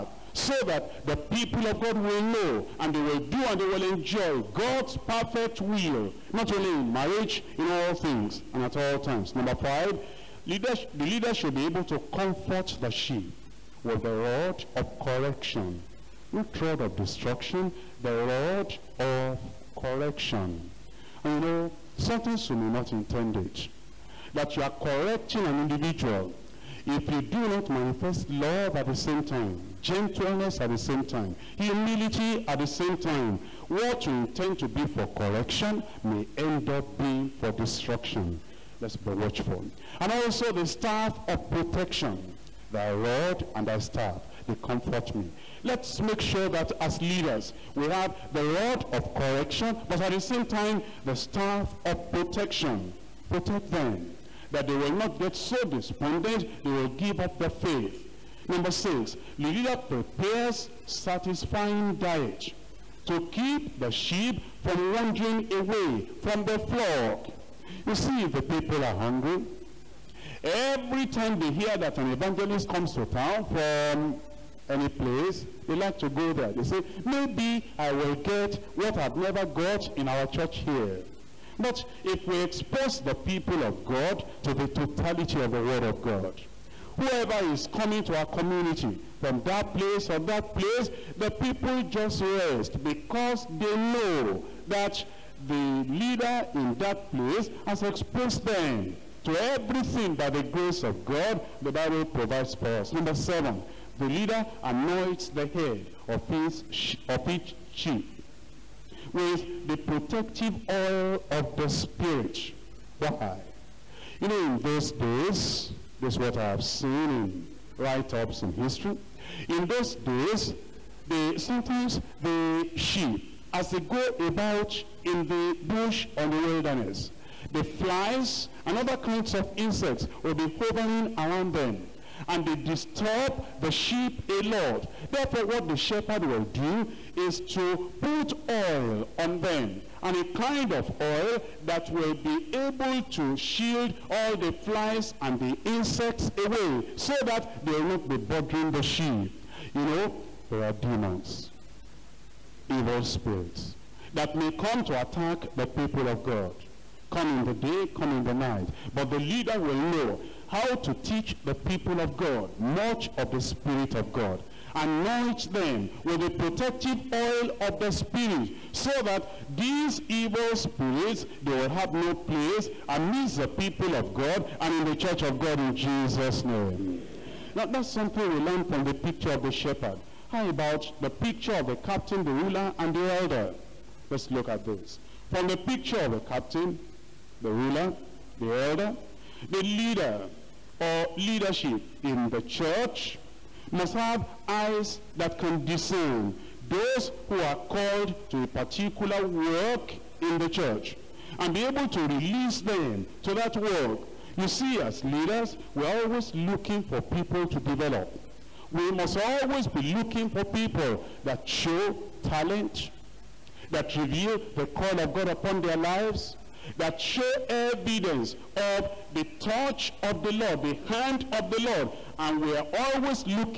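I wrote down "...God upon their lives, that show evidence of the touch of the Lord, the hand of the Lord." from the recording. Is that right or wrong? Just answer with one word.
right.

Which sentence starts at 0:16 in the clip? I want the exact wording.
Not rod of destruction, the rod of correction.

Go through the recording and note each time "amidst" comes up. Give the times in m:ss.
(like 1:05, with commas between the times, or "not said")
2:52.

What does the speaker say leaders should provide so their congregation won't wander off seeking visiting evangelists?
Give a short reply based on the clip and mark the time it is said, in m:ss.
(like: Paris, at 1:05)
Satisfying diet, at 1:00.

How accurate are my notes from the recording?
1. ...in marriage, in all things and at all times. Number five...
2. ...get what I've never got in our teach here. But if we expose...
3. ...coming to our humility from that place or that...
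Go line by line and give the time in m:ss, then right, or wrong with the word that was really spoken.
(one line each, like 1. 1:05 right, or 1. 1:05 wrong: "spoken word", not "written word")
1. 0:06 right
2. 1:18 wrong: "church", not "teach"
3. 1:27 wrong: "community", not "humility".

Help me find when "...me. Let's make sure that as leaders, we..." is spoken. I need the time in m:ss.
0:45.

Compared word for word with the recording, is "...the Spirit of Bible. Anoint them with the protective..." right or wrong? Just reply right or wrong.
wrong.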